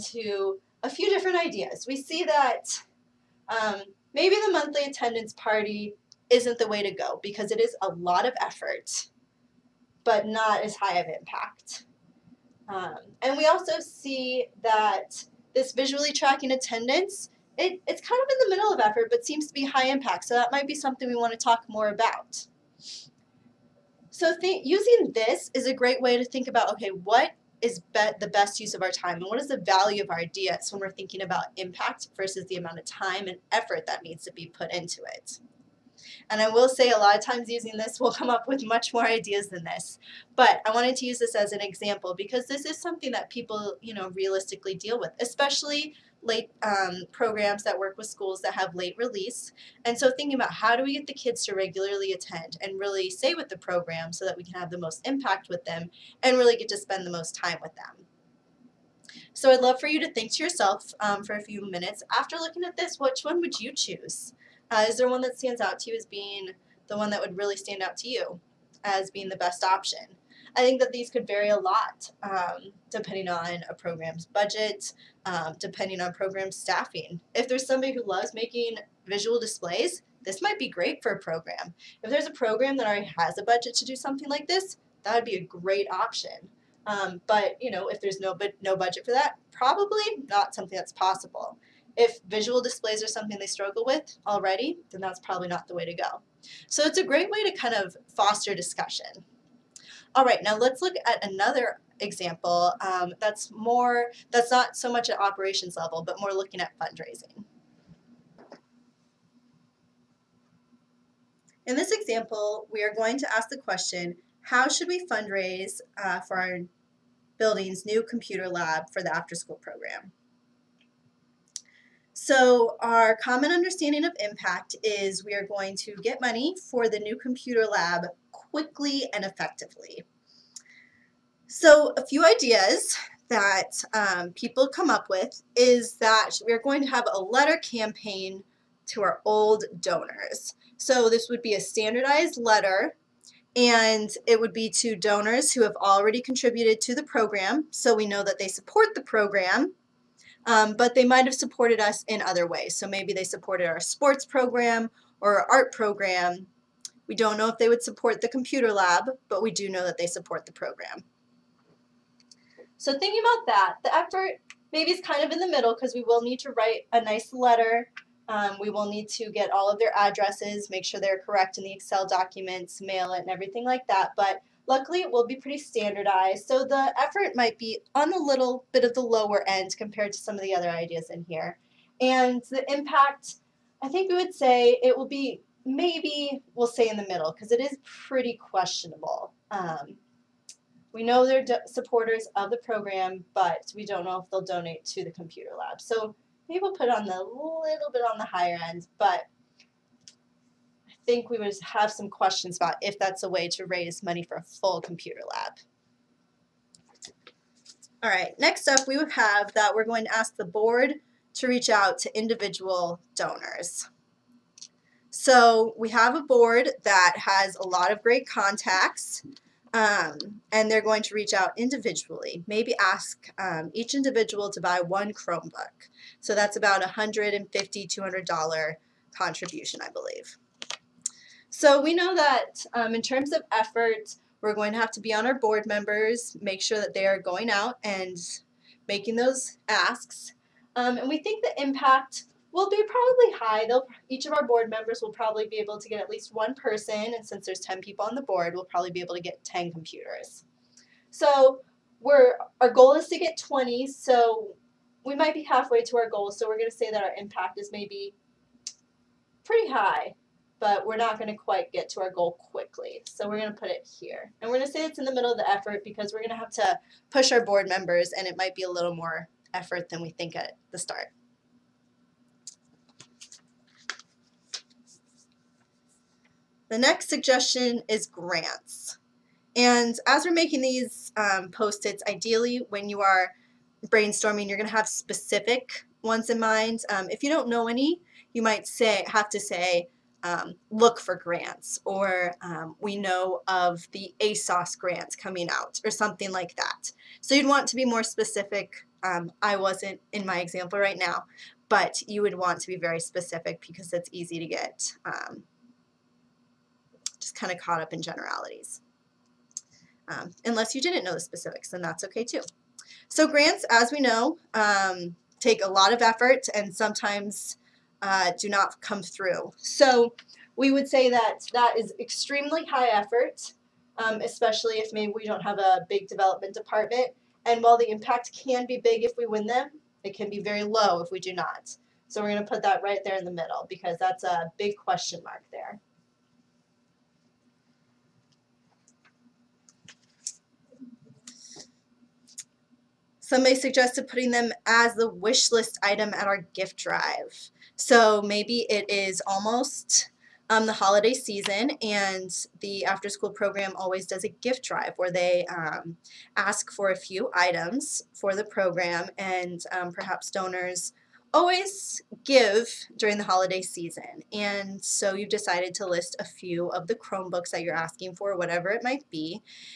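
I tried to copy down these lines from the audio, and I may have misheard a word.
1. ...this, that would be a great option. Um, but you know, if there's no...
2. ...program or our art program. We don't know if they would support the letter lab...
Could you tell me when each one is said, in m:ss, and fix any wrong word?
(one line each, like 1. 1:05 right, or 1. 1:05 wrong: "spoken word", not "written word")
1. 1:24 right
2. 2:34 wrong: "computer", not "letter".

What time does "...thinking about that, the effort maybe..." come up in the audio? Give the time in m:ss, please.
2:42.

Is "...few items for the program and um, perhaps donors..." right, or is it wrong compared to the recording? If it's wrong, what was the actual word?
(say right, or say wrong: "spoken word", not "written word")
right.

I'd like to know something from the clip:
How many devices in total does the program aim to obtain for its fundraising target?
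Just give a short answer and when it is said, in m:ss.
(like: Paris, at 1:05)
20, at 4:13.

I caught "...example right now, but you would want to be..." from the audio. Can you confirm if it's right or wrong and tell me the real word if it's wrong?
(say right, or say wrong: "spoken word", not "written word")
right.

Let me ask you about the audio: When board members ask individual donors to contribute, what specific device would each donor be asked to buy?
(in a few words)
Chromebook.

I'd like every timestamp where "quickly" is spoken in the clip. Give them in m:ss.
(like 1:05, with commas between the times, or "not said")
2:08, 4:22.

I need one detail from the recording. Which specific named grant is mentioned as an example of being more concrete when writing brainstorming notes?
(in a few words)
ASOST grants.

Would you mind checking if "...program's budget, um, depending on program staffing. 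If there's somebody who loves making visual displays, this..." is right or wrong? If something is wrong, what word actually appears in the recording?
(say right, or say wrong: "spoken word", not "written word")
right.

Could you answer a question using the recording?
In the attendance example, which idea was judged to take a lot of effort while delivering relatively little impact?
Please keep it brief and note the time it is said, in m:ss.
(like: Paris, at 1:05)
monthly attendance party, at 0:04.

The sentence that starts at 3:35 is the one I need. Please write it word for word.
So we have a board that has a lot of great contacts um, and they're going to reach out individually.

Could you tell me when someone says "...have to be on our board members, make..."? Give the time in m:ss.
3:54.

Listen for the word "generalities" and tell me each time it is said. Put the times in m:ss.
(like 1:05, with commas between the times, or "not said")
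5:08.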